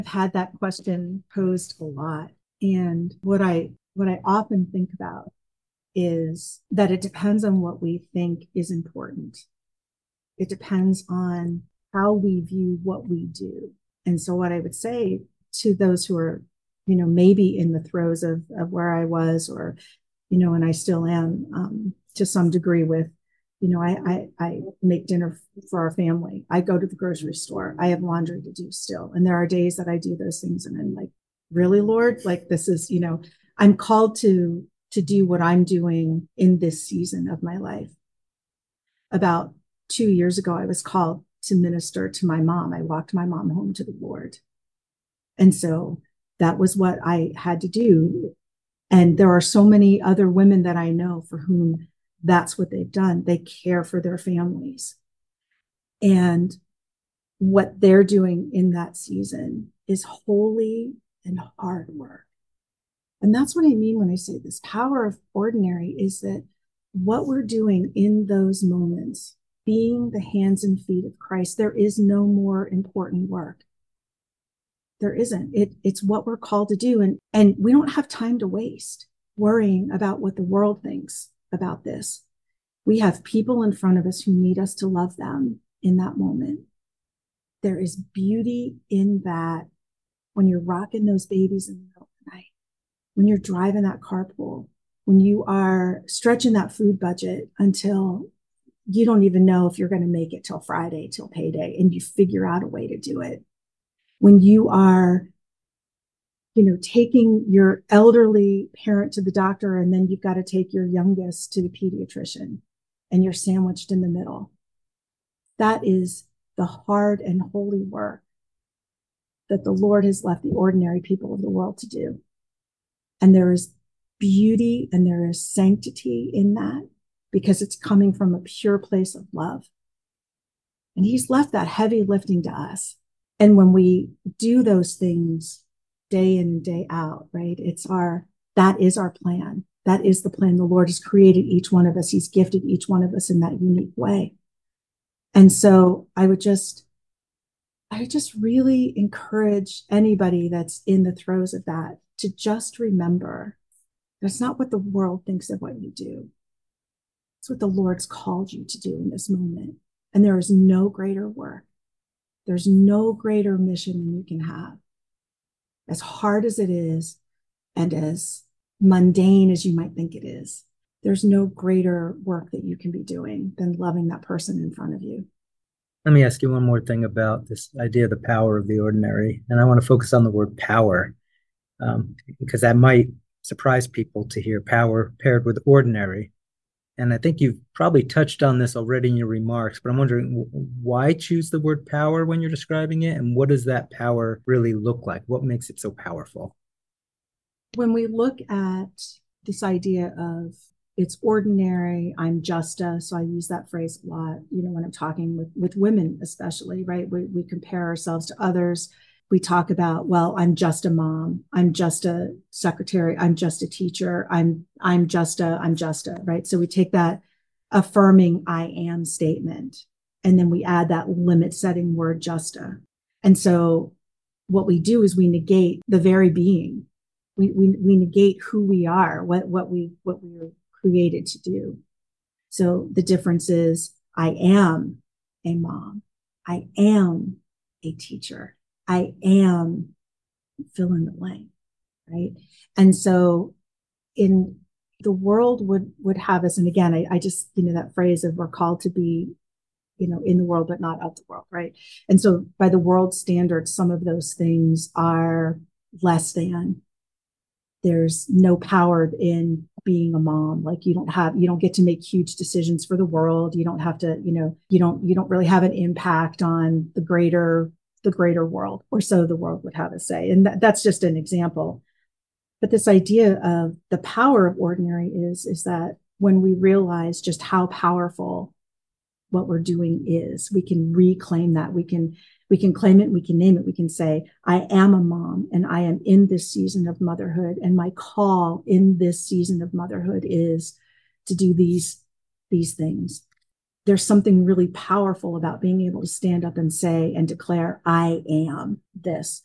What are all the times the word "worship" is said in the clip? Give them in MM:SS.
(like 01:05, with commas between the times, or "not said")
not said.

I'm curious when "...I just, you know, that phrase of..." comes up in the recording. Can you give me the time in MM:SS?
04:07.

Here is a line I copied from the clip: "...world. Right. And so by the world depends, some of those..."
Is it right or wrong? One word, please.
wrong.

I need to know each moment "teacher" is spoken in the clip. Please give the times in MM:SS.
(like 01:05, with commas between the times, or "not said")
03:33, 03:57.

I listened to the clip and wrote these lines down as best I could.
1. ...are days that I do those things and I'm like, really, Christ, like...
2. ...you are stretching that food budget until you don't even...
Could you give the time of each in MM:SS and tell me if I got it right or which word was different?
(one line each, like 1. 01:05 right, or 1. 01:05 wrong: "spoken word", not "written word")
1. 00:29 wrong: "Lord", not "Christ"
2. 01:35 right.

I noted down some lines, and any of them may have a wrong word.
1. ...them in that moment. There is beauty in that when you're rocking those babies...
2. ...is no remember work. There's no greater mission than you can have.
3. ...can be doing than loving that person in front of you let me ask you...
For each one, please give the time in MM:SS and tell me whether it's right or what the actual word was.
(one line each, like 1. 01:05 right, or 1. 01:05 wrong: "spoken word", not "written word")
1. 01:25 right
2. 02:40 wrong: "greater", not "remember"
3. 02:52 right.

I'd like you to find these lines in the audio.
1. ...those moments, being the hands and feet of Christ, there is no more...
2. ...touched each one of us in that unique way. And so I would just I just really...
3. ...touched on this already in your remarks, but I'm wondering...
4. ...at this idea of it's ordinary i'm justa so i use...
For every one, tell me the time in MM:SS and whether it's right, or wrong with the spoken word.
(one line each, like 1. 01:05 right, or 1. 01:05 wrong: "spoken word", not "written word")
1. 01:08 right
2. 02:22 wrong: "gifted", not "touched"
3. 03:08 right
4. 03:18 right.